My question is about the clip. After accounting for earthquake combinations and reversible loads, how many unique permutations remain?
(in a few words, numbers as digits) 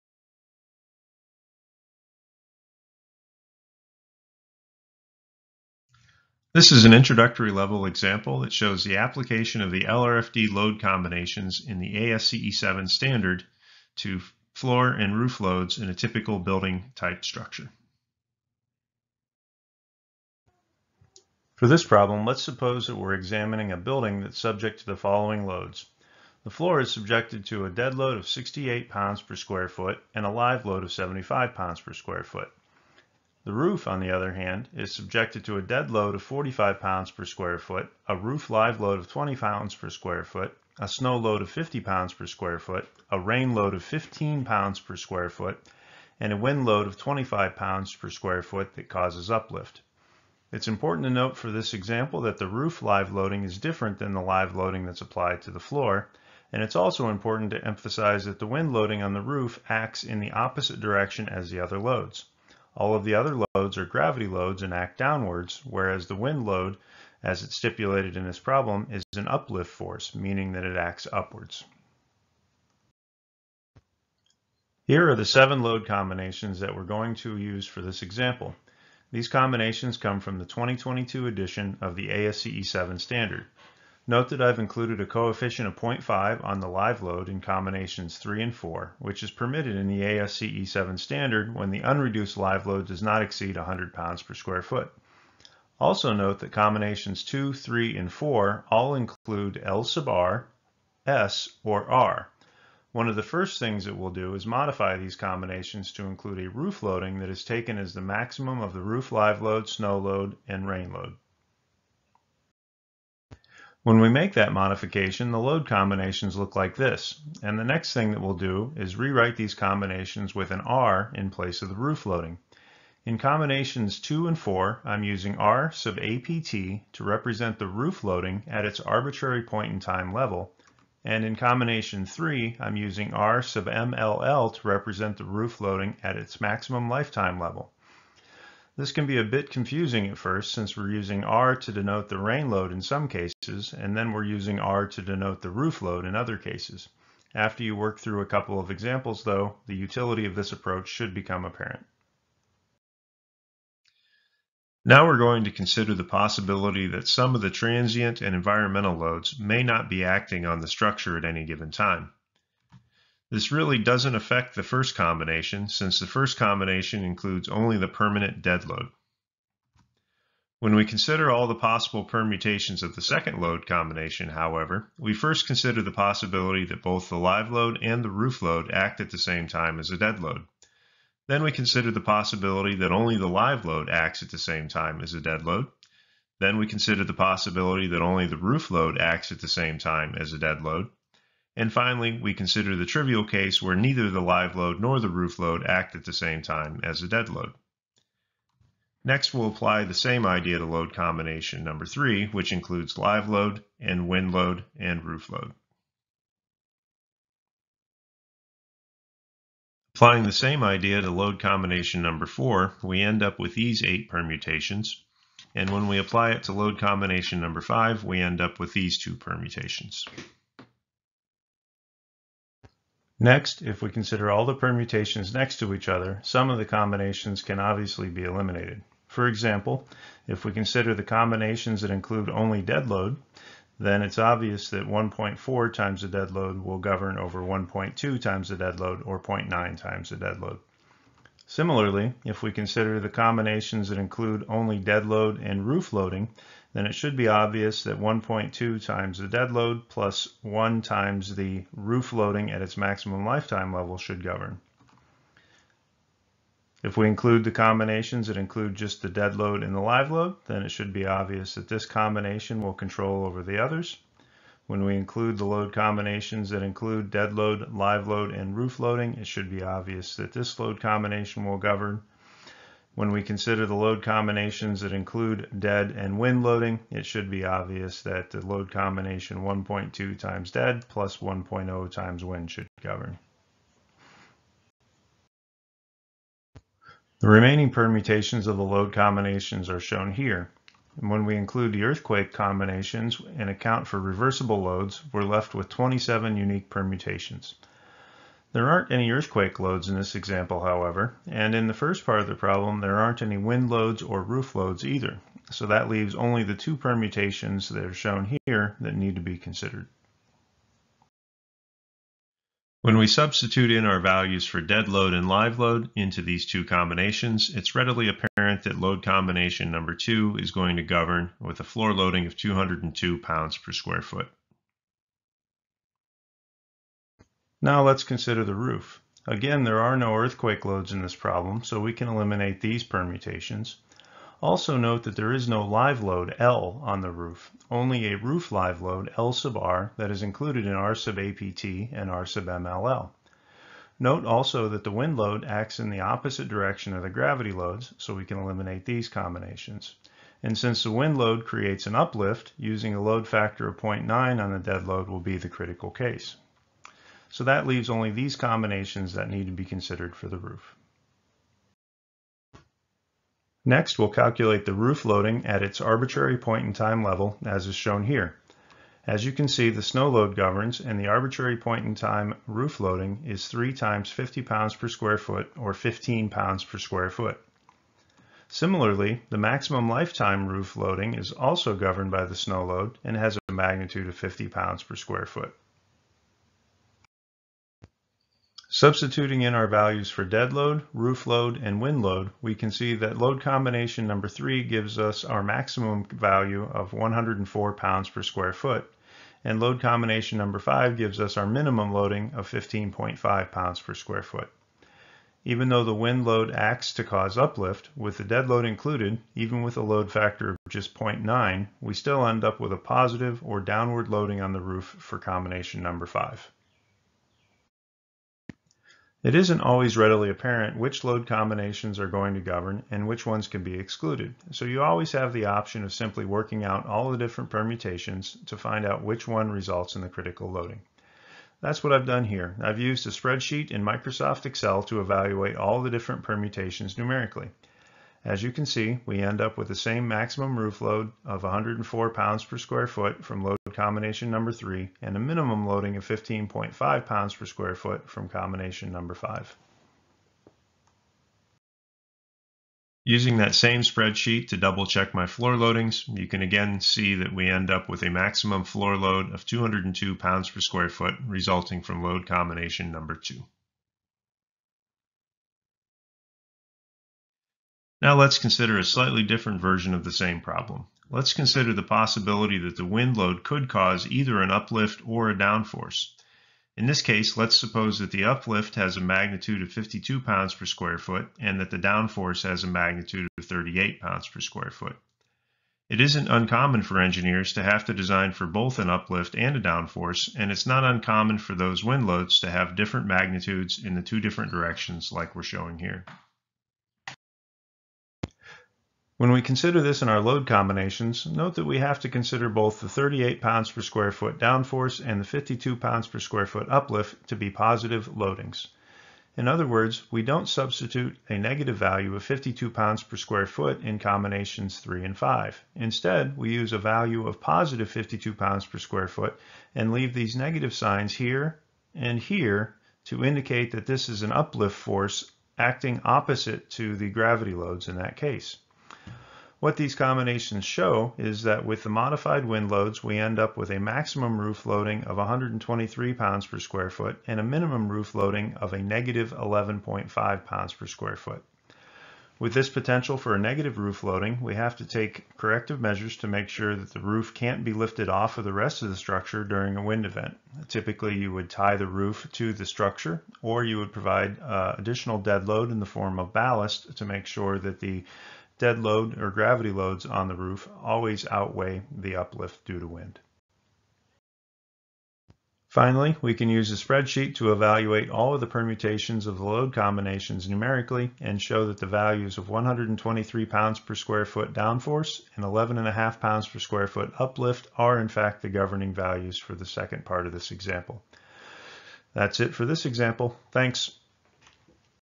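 27.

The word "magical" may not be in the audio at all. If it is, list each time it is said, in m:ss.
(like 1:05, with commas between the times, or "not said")
not said.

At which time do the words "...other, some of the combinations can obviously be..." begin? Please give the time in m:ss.
3:45.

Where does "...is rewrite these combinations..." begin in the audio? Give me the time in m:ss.
1:58.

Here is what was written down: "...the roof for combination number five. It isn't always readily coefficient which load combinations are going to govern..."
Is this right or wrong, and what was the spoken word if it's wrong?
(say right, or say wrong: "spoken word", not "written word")
wrong: "apparent", not "coefficient".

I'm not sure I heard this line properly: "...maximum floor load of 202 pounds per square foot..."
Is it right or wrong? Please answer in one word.
right.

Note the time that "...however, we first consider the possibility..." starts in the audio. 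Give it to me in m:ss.
2:54.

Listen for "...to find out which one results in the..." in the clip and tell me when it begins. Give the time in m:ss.
7:08.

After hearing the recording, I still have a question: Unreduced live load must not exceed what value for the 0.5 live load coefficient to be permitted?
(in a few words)
100 pounds per square foot.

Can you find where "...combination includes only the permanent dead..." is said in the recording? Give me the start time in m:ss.
2:46.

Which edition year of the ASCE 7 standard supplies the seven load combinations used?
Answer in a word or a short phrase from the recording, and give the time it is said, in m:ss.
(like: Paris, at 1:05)
2022, at 1:20.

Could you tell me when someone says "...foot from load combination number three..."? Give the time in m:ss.
7:22.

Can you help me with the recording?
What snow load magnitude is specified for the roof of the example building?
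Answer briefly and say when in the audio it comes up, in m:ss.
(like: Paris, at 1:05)
50 pounds per square foot, at 0:40.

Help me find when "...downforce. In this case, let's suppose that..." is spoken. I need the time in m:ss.
7:55.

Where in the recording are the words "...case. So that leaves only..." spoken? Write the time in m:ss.
5:55.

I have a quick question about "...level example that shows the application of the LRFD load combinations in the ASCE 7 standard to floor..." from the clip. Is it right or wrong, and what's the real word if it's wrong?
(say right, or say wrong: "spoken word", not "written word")
right.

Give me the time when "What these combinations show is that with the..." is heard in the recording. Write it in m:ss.
8:49.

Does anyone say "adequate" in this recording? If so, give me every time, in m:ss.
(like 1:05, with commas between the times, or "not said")
not said.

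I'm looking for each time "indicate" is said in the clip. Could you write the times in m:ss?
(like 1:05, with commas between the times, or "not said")
8:43.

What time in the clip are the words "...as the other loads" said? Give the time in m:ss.
1:01.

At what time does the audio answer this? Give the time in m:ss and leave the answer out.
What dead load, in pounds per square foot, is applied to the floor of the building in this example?
0:28.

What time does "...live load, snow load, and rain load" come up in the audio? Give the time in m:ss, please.
1:49.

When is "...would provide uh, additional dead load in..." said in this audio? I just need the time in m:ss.
9:13.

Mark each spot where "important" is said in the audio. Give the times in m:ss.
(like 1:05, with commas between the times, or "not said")
0:50, 0:57.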